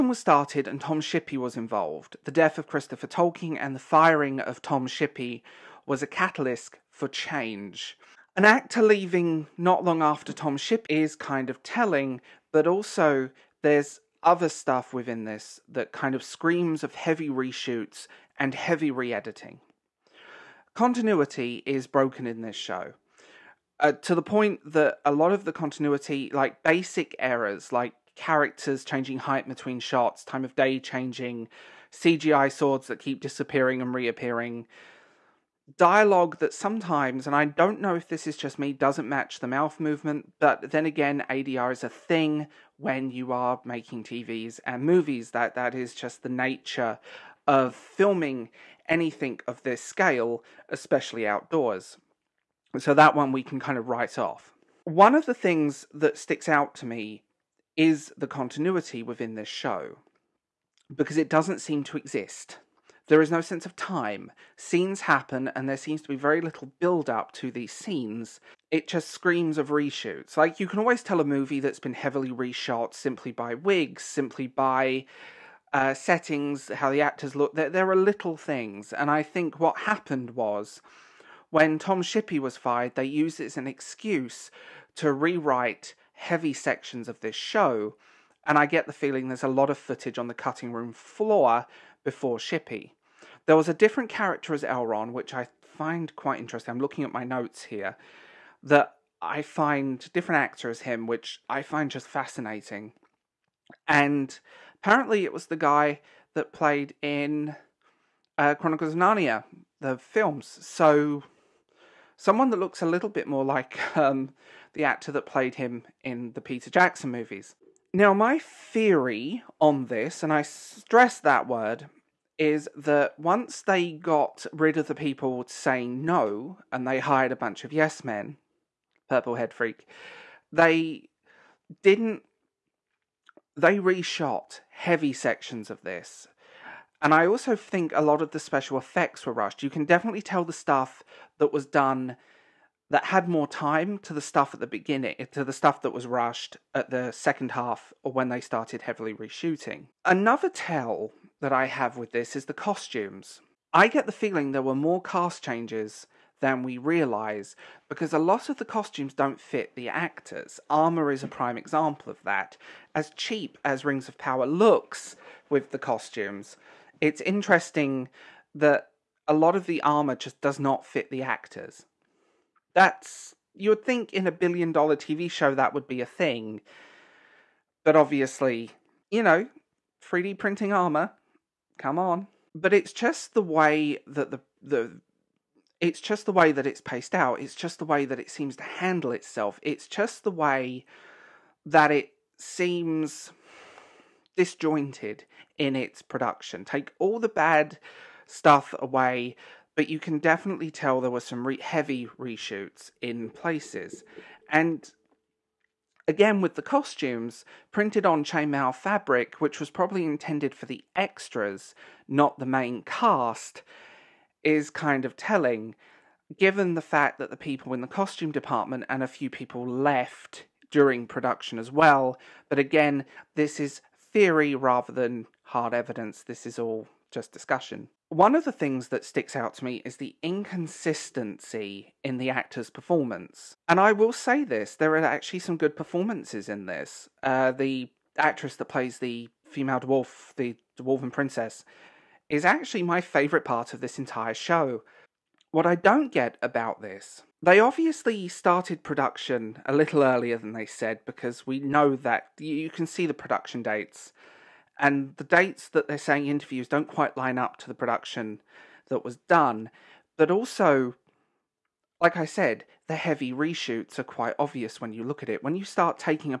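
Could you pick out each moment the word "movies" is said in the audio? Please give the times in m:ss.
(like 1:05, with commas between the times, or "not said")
0:44, 1:11, 1:57.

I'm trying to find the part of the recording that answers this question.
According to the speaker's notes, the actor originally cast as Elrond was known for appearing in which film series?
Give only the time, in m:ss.
1:48.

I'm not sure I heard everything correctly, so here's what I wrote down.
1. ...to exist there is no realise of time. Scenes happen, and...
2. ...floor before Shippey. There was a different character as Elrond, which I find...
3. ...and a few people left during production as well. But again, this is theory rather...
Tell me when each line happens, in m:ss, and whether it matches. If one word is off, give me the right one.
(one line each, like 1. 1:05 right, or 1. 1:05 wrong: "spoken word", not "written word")
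1. 1:01 wrong: "sense", not "realise"
2. 1:30 right
3. 3:38 right.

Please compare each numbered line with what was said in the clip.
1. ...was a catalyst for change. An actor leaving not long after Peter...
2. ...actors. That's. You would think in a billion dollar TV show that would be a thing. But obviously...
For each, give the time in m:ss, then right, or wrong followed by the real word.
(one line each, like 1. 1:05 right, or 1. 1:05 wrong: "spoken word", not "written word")
1. 0:05 wrong: "Tom", not "Peter"
2. 2:51 right.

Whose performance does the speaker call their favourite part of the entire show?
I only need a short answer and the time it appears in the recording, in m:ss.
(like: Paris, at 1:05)
The dwarven princess, at 4:00.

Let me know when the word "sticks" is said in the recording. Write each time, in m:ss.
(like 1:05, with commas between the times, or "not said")
0:56, 3:49.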